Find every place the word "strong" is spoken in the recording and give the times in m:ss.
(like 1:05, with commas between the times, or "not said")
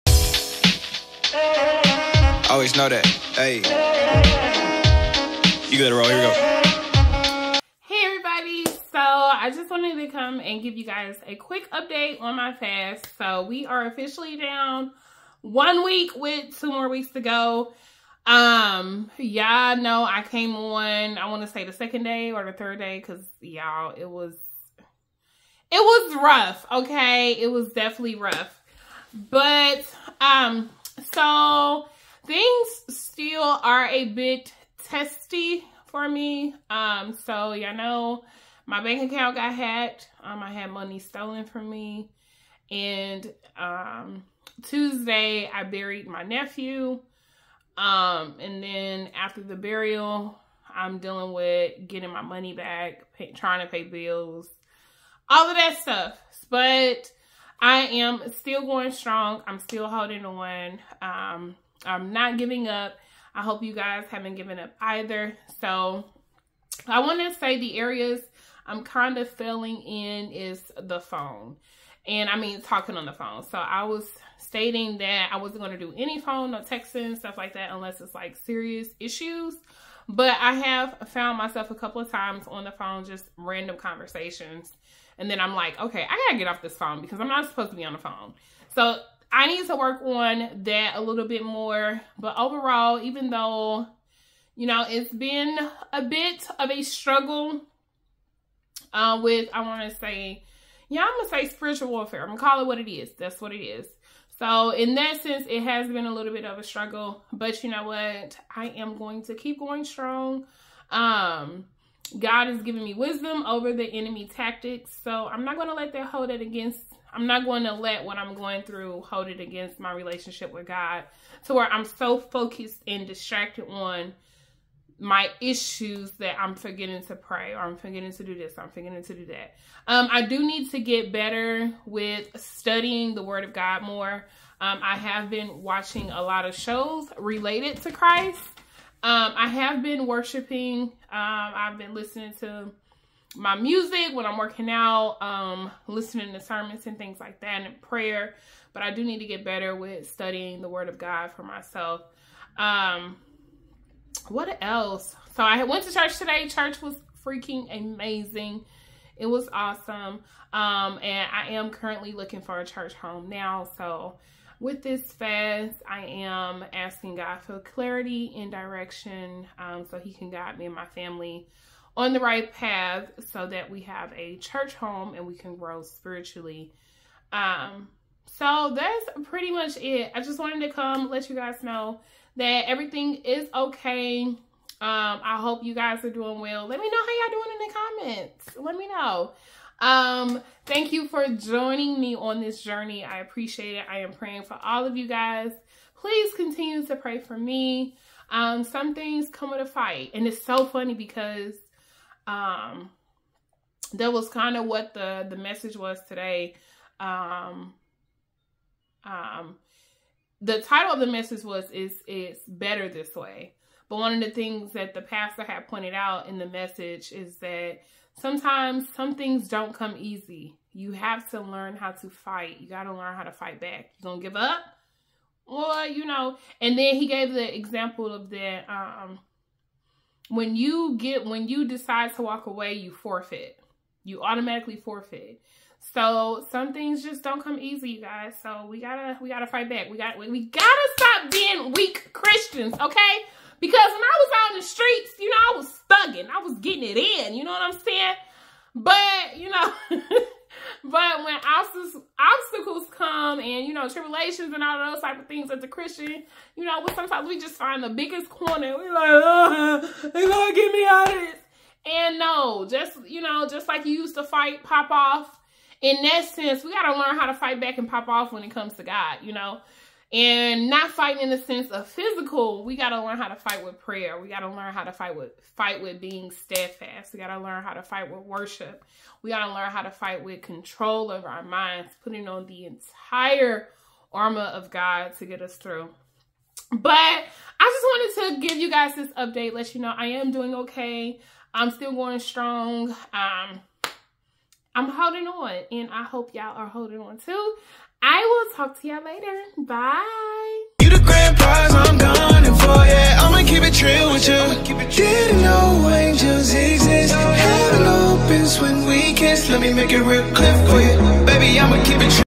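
0:58, 1:49, 4:52.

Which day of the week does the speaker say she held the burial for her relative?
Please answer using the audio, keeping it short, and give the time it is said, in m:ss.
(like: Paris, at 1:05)
Tuesday, at 0:44.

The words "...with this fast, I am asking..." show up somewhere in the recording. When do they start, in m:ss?
2:44.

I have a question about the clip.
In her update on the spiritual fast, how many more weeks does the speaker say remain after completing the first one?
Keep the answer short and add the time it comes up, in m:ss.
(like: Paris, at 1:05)
2, at 0:16.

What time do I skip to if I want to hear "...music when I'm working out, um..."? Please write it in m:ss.
2:23.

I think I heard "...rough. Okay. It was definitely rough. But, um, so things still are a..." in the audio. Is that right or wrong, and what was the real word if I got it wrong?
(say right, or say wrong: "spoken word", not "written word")
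right.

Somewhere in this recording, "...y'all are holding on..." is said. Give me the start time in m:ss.
4:56.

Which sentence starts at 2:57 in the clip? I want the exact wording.
Um, so that's pretty much it.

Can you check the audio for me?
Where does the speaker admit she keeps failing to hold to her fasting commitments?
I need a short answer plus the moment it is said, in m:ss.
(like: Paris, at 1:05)
talking on the phone, at 1:12.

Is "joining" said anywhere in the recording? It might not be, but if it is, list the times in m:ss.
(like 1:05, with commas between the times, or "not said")
3:11.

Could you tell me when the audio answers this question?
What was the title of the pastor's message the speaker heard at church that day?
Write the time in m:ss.
3:32.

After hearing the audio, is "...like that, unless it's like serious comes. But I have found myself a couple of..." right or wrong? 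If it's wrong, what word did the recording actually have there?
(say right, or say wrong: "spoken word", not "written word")
wrong: "issues", not "comes".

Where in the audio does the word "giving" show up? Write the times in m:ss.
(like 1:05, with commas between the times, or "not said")
1:02, 1:52.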